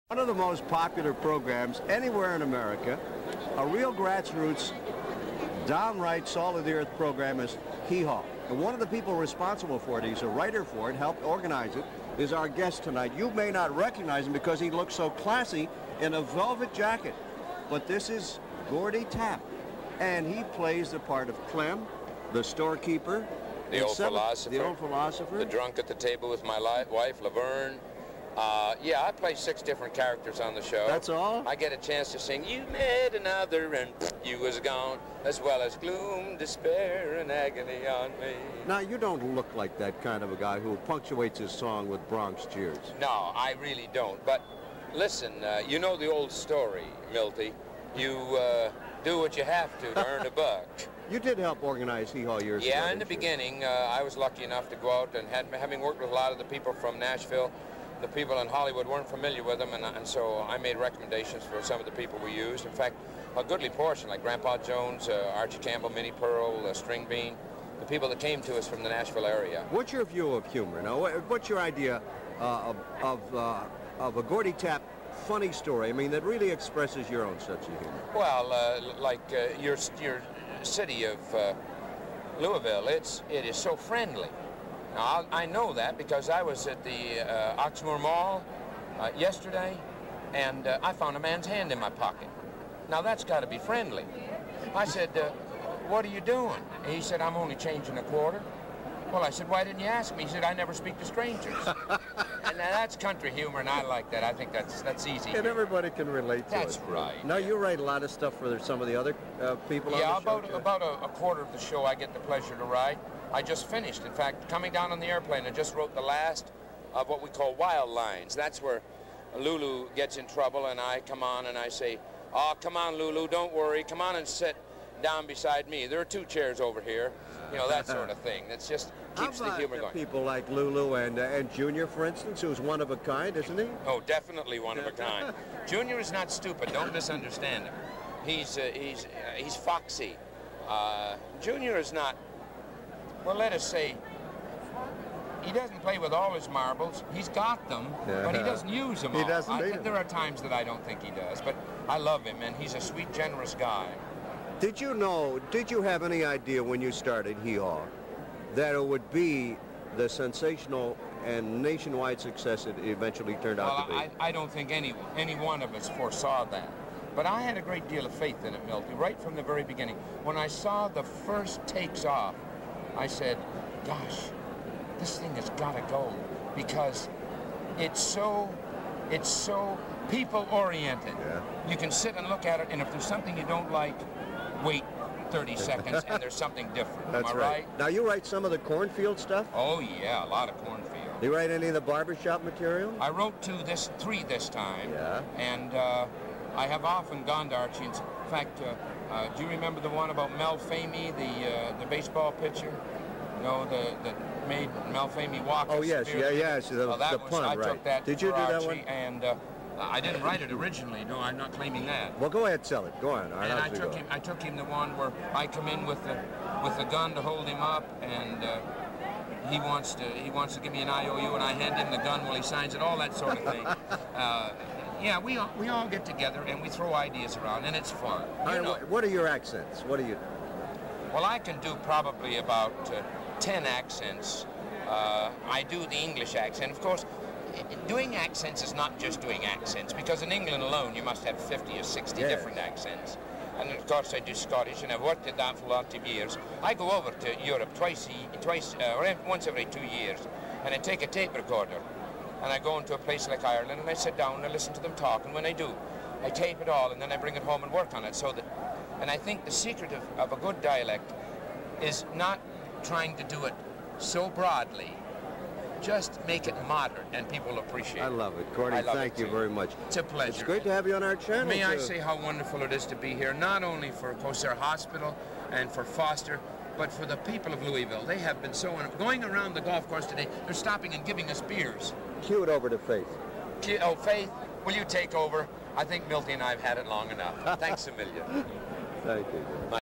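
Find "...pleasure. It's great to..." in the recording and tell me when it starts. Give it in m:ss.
4:30.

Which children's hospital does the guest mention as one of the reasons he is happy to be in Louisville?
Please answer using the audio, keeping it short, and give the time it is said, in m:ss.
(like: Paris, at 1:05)
Kosair Hospital, at 4:34.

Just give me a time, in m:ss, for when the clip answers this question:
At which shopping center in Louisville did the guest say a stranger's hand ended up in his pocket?
1:27.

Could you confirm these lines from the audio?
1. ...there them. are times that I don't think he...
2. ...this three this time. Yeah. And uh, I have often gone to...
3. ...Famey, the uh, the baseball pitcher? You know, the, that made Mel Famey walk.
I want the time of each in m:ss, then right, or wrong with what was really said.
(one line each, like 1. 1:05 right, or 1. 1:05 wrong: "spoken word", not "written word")
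1. 2:29 right
2. 3:13 right
3. 3:20 right.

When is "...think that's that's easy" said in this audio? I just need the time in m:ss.
1:44.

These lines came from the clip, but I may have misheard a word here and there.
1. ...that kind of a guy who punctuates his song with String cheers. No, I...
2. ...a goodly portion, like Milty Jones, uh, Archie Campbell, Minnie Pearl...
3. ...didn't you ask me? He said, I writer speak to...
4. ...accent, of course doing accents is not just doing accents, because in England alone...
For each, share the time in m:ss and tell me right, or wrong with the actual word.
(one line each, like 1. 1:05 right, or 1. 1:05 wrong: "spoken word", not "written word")
1. 0:39 wrong: "Bronx", not "String"
2. 1:03 wrong: "Grandpa", not "Milty"
3. 1:39 wrong: "never", not "writer"
4. 3:56 right.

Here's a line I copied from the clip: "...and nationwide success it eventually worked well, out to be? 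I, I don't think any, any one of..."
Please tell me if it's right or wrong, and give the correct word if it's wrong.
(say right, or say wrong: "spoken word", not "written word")
wrong: "turned", not "worked".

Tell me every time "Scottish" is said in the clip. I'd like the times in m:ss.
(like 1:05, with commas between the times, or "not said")
4:04.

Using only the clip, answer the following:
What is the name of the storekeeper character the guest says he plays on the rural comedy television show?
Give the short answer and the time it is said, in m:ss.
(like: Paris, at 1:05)
Clem, at 0:21.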